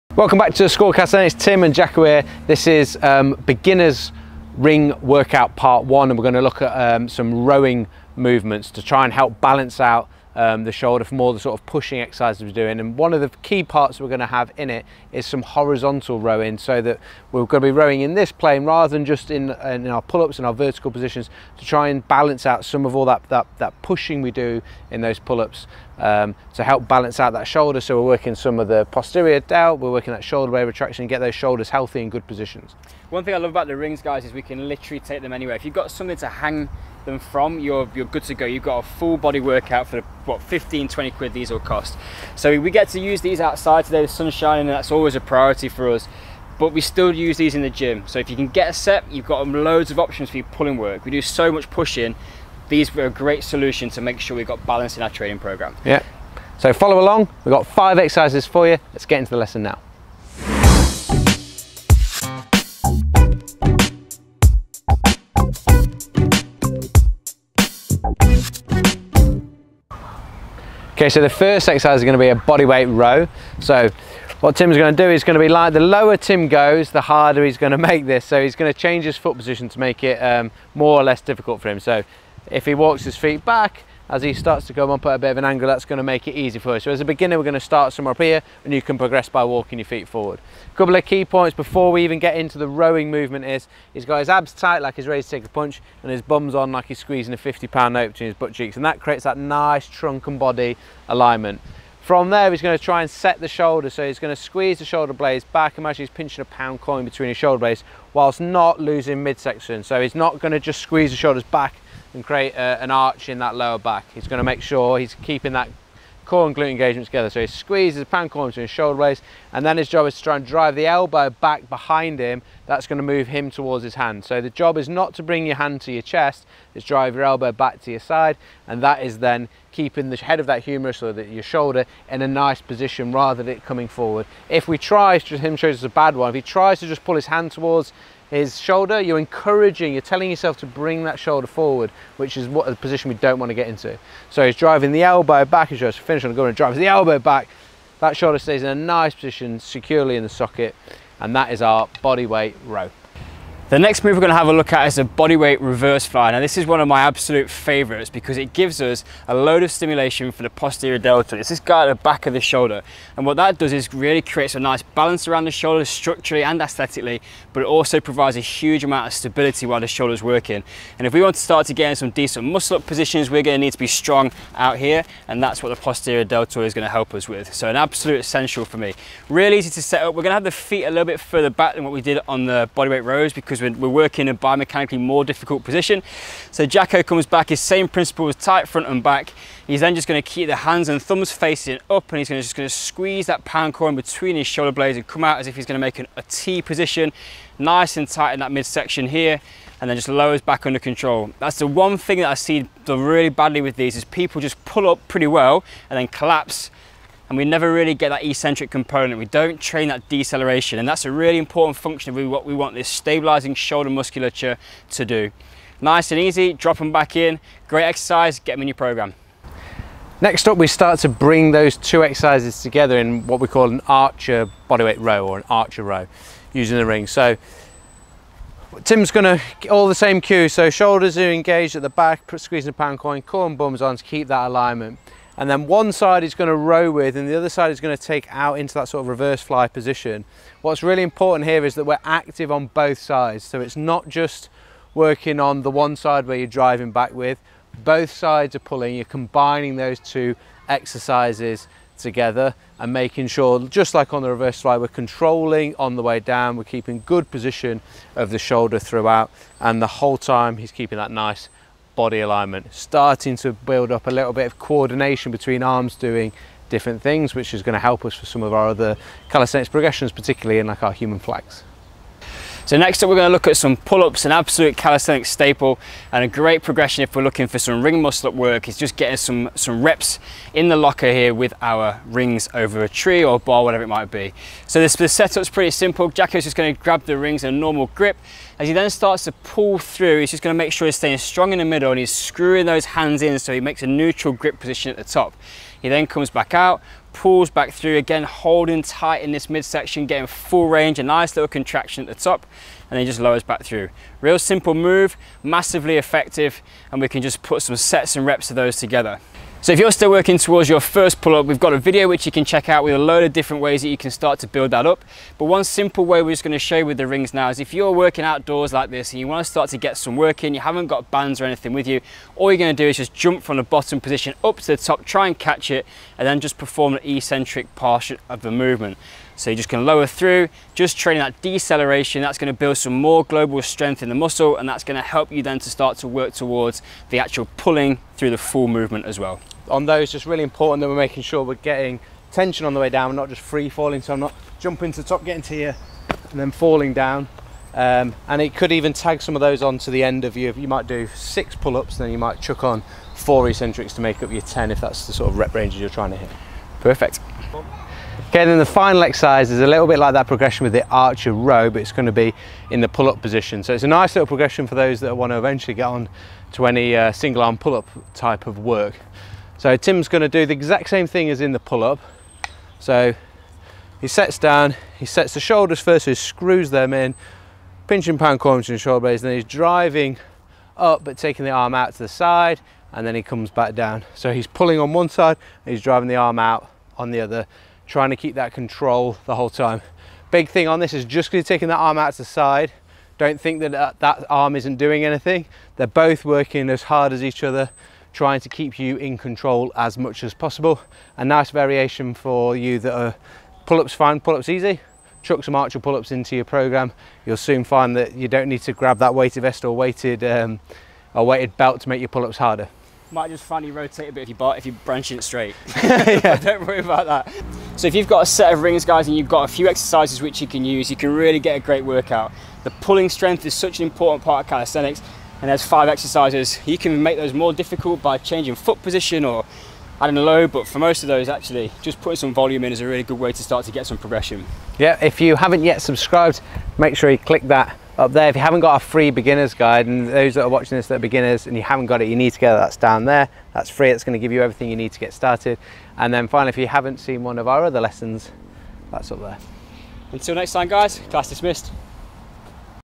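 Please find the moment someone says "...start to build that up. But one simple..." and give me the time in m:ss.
5:14.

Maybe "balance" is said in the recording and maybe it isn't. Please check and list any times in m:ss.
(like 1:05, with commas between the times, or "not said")
0:09, 0:22, 0:26, 0:54, 2:44.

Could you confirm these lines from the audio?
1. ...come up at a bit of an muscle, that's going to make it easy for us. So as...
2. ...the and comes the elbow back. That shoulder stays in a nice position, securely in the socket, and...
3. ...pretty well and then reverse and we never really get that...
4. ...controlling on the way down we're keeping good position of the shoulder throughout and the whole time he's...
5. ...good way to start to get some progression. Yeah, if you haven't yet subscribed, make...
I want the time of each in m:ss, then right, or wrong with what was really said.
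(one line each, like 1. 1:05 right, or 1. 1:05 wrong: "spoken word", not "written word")
1. 1:24 wrong: "angle", not "muscle"
2. 2:26 wrong: "drives", not "comes"
3. 3:25 wrong: "collapse", not "reverse"
4. 4:14 right
5. 7:13 right.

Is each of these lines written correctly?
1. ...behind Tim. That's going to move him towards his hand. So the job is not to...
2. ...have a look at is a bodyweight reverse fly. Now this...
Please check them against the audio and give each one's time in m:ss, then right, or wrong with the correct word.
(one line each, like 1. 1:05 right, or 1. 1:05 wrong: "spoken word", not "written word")
1. 2:01 right
2. 2:34 right.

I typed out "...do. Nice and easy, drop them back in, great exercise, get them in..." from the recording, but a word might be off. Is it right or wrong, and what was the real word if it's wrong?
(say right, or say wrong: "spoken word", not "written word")
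right.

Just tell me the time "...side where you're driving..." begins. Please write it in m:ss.
4:05.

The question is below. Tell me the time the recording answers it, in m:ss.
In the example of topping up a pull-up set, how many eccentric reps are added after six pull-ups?
5:53.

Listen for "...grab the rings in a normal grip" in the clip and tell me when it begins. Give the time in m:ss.
4:46.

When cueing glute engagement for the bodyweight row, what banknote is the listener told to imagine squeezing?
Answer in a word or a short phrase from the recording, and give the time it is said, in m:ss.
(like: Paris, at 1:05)
a 50 pound note, at 1:37.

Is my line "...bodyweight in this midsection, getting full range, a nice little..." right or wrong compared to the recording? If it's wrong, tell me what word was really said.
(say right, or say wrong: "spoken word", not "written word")
wrong: "tight", not "bodyweight".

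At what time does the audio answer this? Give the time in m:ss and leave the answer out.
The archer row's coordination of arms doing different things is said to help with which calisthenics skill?
4:31.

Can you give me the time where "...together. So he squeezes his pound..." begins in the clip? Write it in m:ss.
1:57.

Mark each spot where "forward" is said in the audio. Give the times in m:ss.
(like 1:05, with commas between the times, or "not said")
1:30, 2:13, 2:21.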